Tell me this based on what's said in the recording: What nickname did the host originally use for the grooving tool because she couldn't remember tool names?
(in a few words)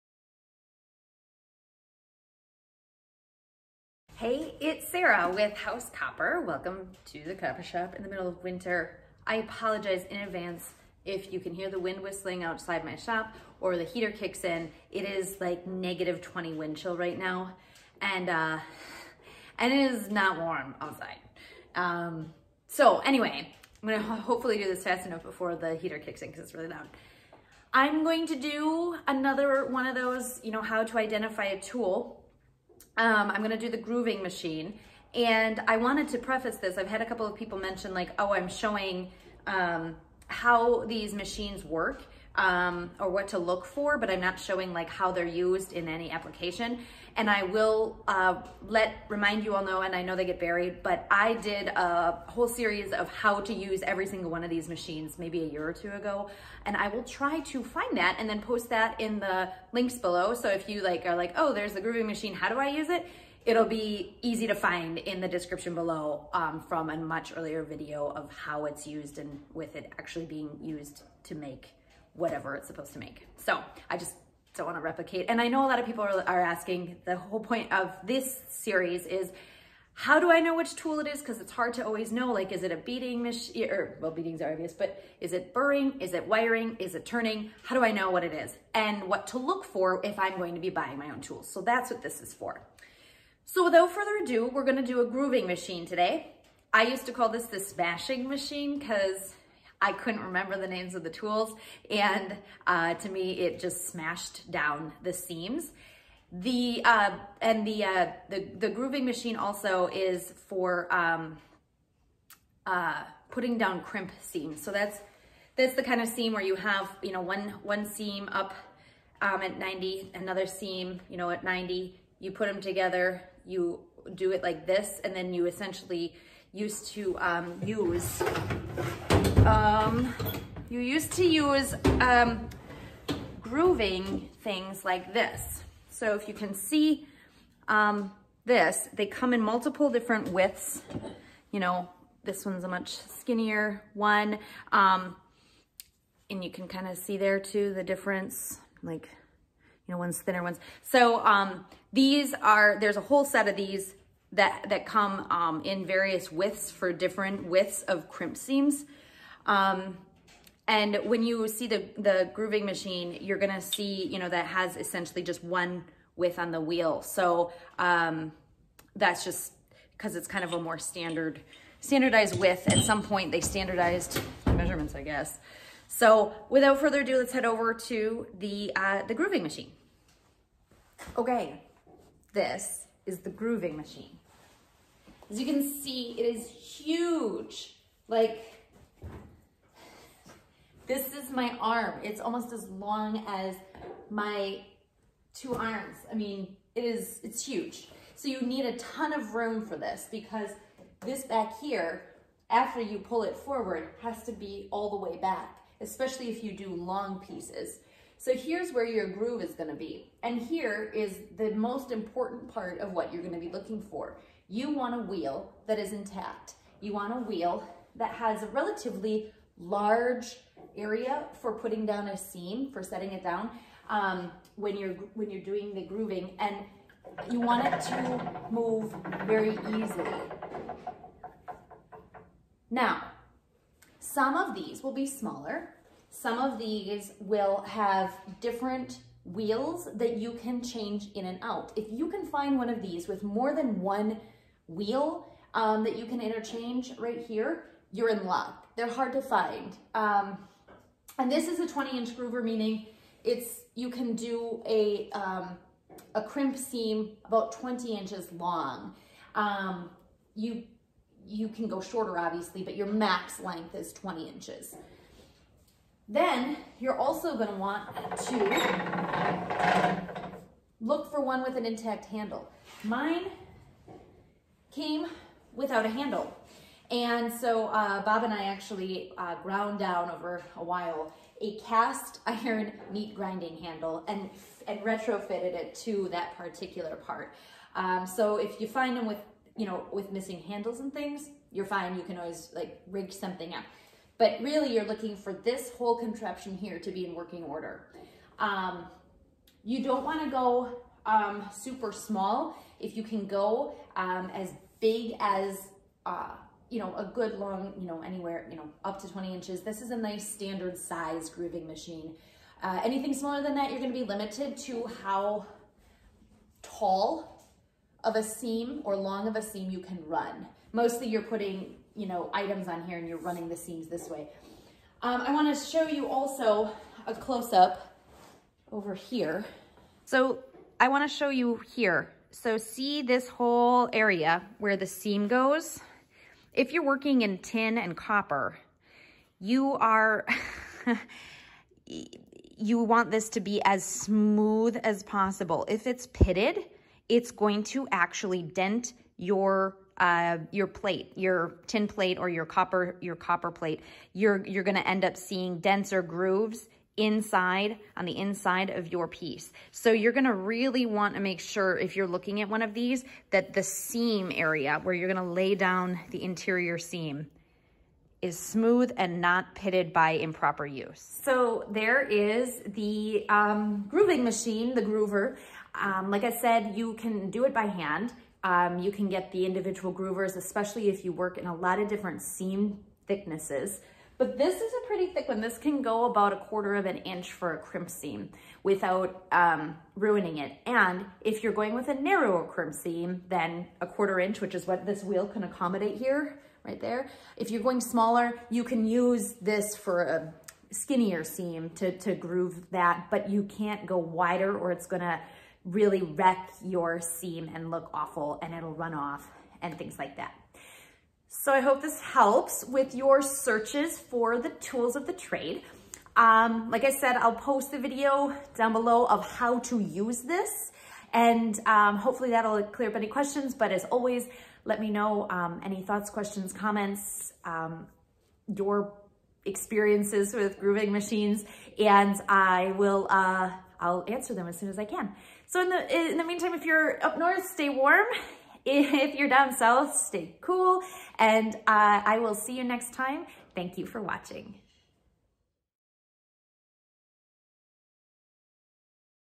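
smashing machine.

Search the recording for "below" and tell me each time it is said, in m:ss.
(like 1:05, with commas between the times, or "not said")
0:59, 1:05, 6:58.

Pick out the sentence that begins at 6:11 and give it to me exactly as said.
So there is the um, grooving machine, the groover.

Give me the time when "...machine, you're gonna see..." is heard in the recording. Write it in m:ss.
2:42.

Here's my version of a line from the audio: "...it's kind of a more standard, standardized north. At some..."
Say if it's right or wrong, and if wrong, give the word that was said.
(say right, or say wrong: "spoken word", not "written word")
wrong: "width", not "north".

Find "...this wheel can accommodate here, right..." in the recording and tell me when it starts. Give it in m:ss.
6:34.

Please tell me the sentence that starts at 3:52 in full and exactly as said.
Now, some of these will be smaller some of these will have different wheels that you can change in and out.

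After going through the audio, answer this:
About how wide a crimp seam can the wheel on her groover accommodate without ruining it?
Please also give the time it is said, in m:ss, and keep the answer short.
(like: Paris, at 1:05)
a quarter of an inch, at 6:26.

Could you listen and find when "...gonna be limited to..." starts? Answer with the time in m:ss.
5:13.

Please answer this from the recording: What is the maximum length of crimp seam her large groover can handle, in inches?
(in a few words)
20 inches.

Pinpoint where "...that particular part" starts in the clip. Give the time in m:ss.
4:46.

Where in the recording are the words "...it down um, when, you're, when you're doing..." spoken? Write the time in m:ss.
3:43.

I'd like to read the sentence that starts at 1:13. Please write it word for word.
So I just don't want to replicate.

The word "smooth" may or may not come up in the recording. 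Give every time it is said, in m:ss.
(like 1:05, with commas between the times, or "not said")
5:43, 6:08.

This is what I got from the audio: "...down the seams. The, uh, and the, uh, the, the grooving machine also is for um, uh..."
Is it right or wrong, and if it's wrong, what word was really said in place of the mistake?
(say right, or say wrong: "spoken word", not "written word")
right.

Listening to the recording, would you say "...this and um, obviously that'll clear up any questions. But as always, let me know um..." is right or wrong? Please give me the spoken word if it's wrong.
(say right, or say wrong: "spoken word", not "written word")
wrong: "hopefully", not "obviously".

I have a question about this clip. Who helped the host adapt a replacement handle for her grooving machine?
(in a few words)
Bob.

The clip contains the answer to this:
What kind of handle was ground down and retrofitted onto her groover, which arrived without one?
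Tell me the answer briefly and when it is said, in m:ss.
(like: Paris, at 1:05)
cast iron meat grinding handle, at 4:41.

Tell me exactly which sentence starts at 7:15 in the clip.
So in the, in the meantime, if you're up north, stay warm.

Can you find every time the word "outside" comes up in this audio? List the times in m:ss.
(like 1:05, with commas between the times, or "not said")
0:12, 0:20.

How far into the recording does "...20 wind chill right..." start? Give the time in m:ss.
0:16.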